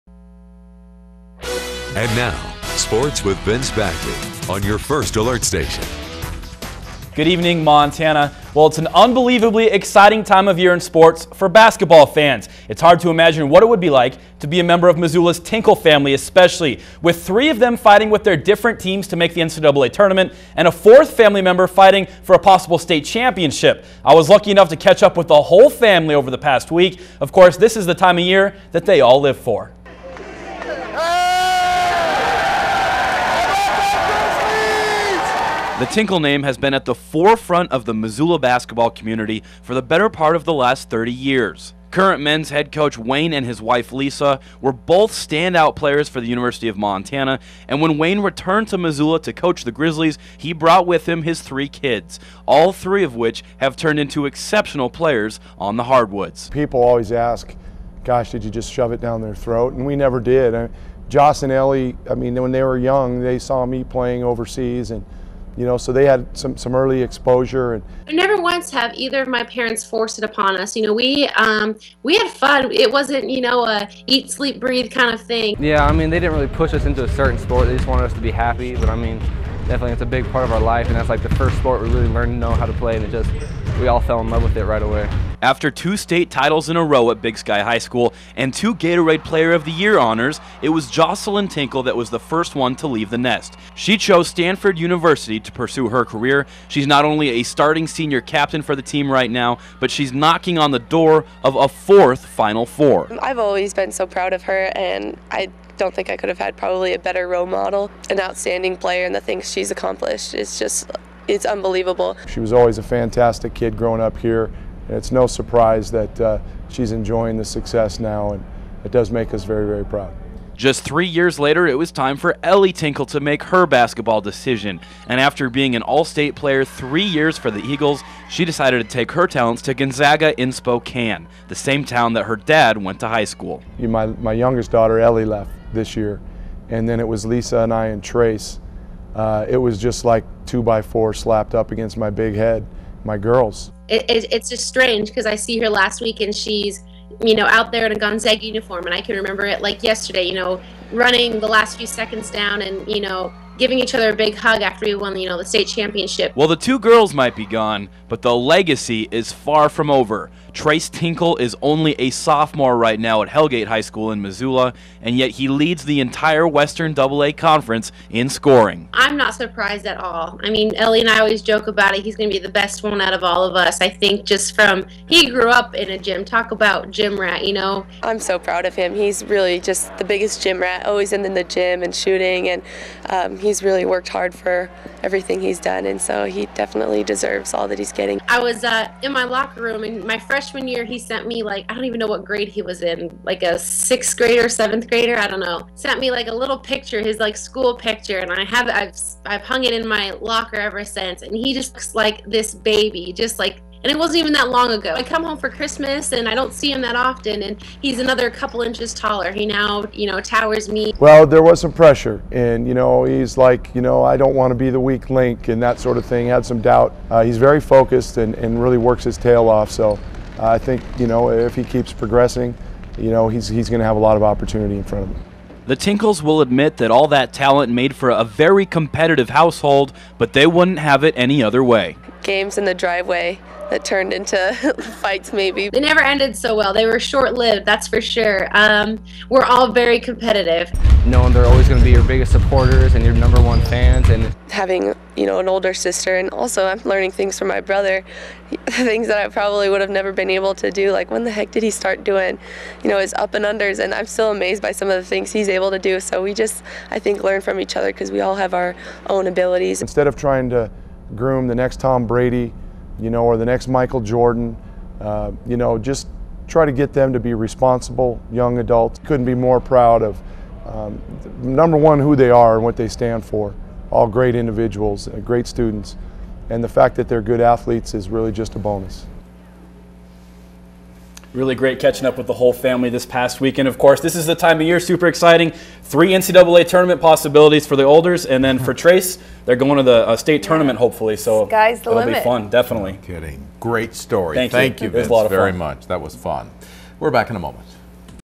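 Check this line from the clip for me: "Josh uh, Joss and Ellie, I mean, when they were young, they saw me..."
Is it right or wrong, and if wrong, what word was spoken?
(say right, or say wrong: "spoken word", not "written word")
right.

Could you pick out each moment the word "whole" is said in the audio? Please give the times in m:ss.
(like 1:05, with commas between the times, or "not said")
0:25, 4:42.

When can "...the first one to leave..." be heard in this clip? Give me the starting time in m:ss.
1:32.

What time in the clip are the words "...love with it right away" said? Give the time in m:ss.
1:24.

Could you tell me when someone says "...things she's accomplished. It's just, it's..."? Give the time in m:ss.
1:49.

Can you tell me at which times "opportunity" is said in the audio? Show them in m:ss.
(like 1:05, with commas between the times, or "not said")
3:44.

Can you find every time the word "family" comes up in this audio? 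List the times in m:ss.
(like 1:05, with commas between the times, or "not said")
0:15, 0:21, 0:25, 4:42.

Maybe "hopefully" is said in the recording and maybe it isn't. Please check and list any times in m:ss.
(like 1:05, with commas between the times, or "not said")
4:50.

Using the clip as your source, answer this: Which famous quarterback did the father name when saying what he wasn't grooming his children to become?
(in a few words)
Tom Brady.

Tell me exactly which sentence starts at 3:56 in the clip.
They were short lived, that's for sure.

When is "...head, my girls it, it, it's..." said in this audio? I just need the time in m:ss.
2:22.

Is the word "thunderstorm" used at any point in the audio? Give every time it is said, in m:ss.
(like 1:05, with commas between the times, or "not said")
not said.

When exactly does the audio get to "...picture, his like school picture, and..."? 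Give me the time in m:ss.
3:16.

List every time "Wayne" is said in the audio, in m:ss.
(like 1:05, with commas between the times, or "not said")
0:42, 0:47.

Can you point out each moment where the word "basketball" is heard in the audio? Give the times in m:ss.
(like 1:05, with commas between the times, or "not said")
0:11, 0:38, 2:03.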